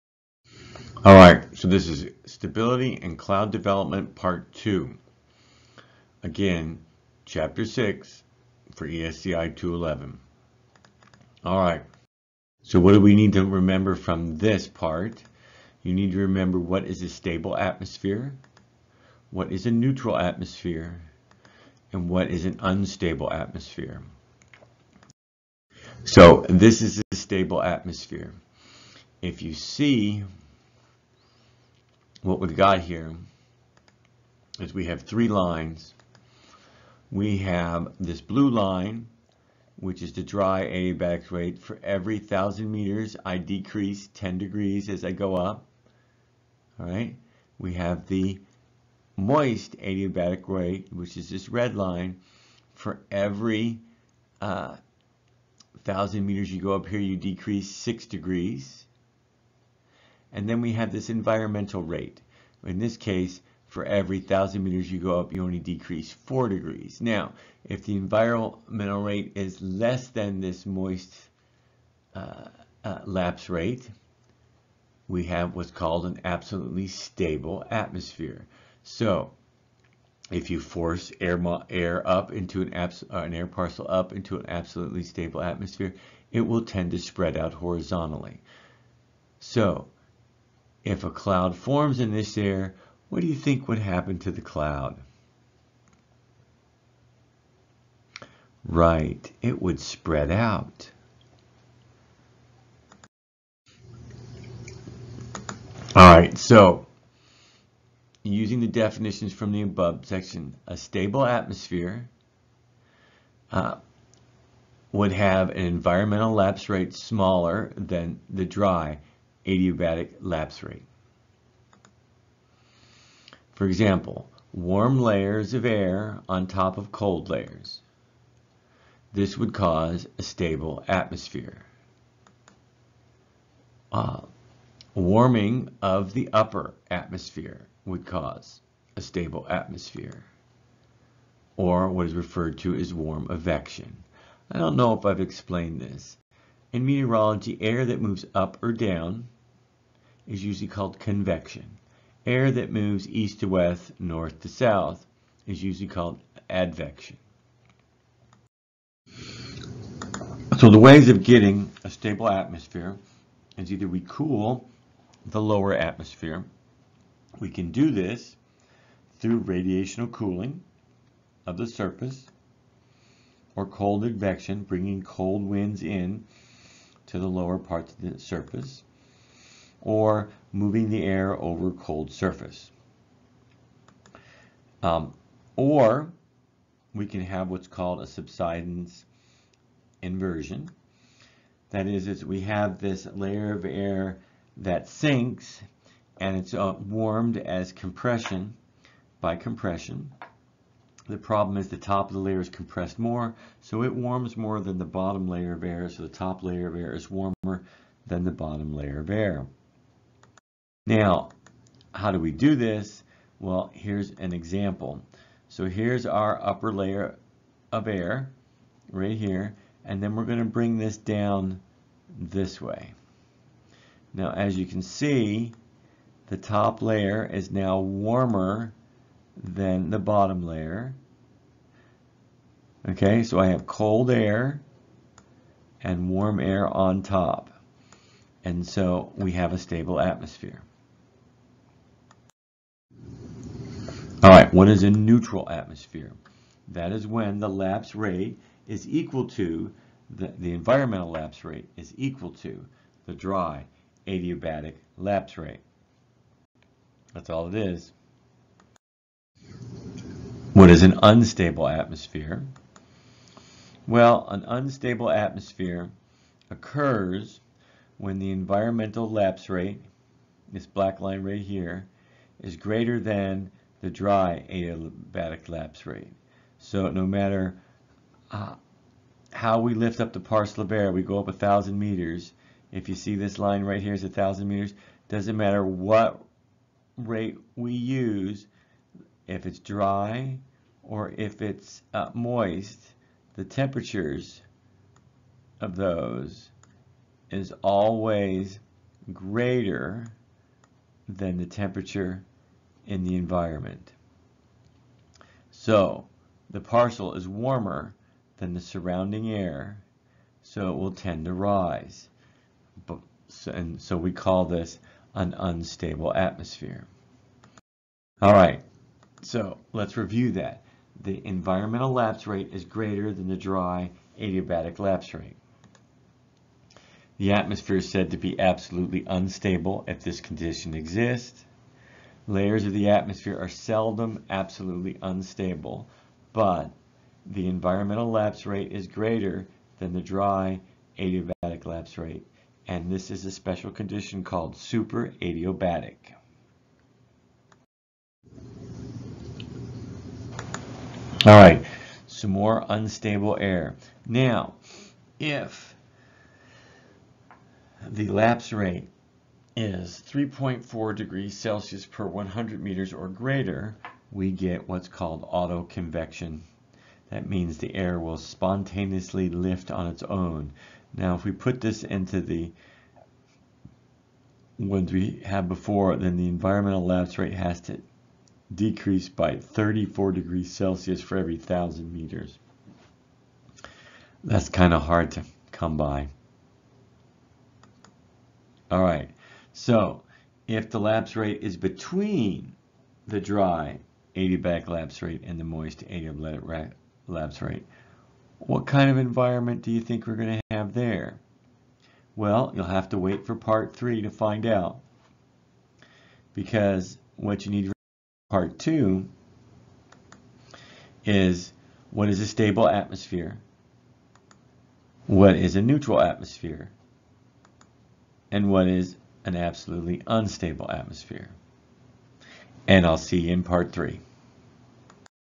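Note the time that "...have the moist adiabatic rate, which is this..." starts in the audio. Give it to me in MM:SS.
00:47.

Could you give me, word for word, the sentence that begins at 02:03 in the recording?
For example, warm layers of air on top of cold layers.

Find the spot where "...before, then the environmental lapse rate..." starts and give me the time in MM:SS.
06:15.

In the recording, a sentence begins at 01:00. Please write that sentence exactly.
And then we have this environmental rate.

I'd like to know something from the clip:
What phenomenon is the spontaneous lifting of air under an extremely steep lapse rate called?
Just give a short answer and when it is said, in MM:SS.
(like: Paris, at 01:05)
autoconvection, at 06:05.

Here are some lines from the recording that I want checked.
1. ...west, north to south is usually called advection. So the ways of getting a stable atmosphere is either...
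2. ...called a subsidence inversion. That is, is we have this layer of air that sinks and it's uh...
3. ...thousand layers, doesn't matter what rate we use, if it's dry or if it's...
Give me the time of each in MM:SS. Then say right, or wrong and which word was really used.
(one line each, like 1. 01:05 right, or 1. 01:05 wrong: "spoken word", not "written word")
1. 02:33 right
2. 03:07 right
3. 04:44 wrong: "meters", not "layers".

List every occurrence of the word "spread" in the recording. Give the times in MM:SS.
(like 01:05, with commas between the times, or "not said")
01:26, 01:39.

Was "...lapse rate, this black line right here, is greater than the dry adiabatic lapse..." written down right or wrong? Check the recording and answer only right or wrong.
right.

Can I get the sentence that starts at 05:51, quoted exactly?
All right, some more unstable air.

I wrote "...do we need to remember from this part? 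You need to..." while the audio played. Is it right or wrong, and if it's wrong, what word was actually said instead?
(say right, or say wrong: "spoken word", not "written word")
right.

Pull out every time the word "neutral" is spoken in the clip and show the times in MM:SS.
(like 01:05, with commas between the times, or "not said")
00:19, 04:04, 06:55.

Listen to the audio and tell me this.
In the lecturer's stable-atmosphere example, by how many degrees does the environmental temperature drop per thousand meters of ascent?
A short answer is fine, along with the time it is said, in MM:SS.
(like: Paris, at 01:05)
4 degrees, at 01:05.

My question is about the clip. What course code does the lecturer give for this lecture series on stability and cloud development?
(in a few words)
ESCI 211.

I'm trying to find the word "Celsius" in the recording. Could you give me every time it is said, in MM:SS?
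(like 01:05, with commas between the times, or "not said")
06:01, 06:20.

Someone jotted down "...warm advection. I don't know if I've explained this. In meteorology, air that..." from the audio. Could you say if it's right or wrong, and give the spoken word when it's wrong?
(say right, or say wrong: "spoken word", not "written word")
right.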